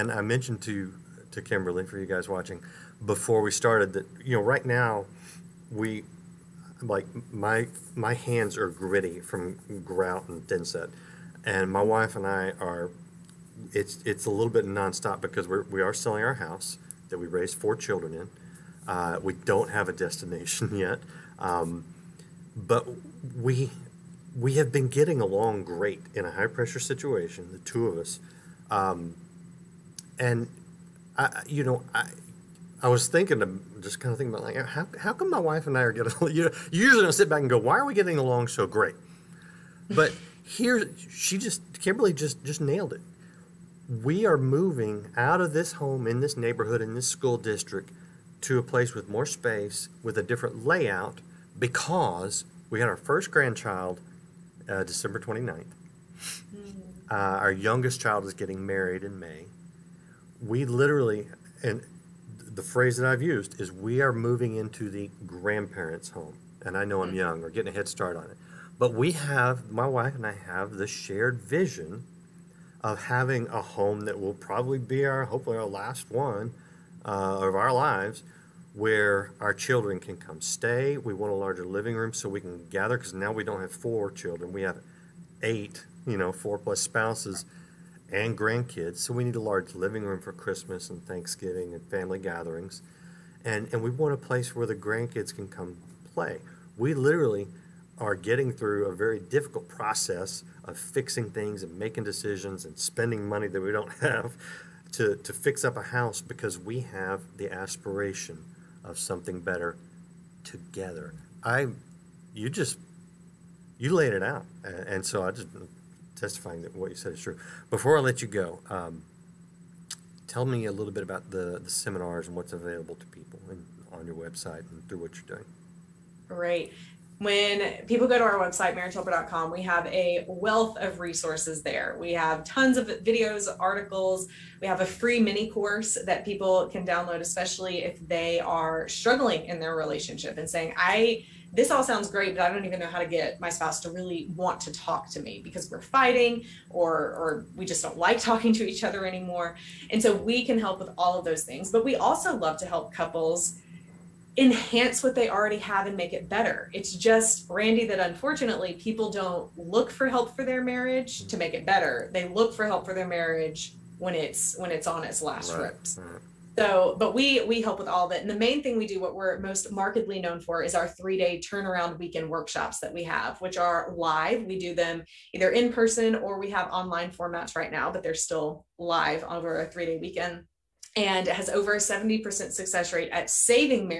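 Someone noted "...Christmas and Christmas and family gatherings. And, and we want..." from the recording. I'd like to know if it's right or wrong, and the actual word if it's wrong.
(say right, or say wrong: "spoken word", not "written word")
wrong: "Thanksgiving", not "Christmas".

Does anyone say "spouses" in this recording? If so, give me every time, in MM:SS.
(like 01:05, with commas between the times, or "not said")
01:26, 02:23.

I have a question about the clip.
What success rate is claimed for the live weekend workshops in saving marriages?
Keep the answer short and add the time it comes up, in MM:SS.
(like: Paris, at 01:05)
over 70%, at 03:01.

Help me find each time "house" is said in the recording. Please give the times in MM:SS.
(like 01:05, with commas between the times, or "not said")
00:16, 01:45.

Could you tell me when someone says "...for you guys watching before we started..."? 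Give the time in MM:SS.
00:01.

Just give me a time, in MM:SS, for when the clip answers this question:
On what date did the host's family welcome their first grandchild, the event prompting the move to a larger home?
00:54.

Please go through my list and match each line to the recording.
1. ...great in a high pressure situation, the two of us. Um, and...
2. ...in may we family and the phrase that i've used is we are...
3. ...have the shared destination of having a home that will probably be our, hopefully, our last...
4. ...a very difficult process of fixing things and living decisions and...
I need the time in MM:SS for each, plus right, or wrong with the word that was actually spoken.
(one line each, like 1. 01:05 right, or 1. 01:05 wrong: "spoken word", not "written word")
1. 00:25 right
2. 00:59 wrong: "literally", not "family"
3. 01:10 wrong: "vision", not "destination"
4. 01:38 wrong: "making", not "living".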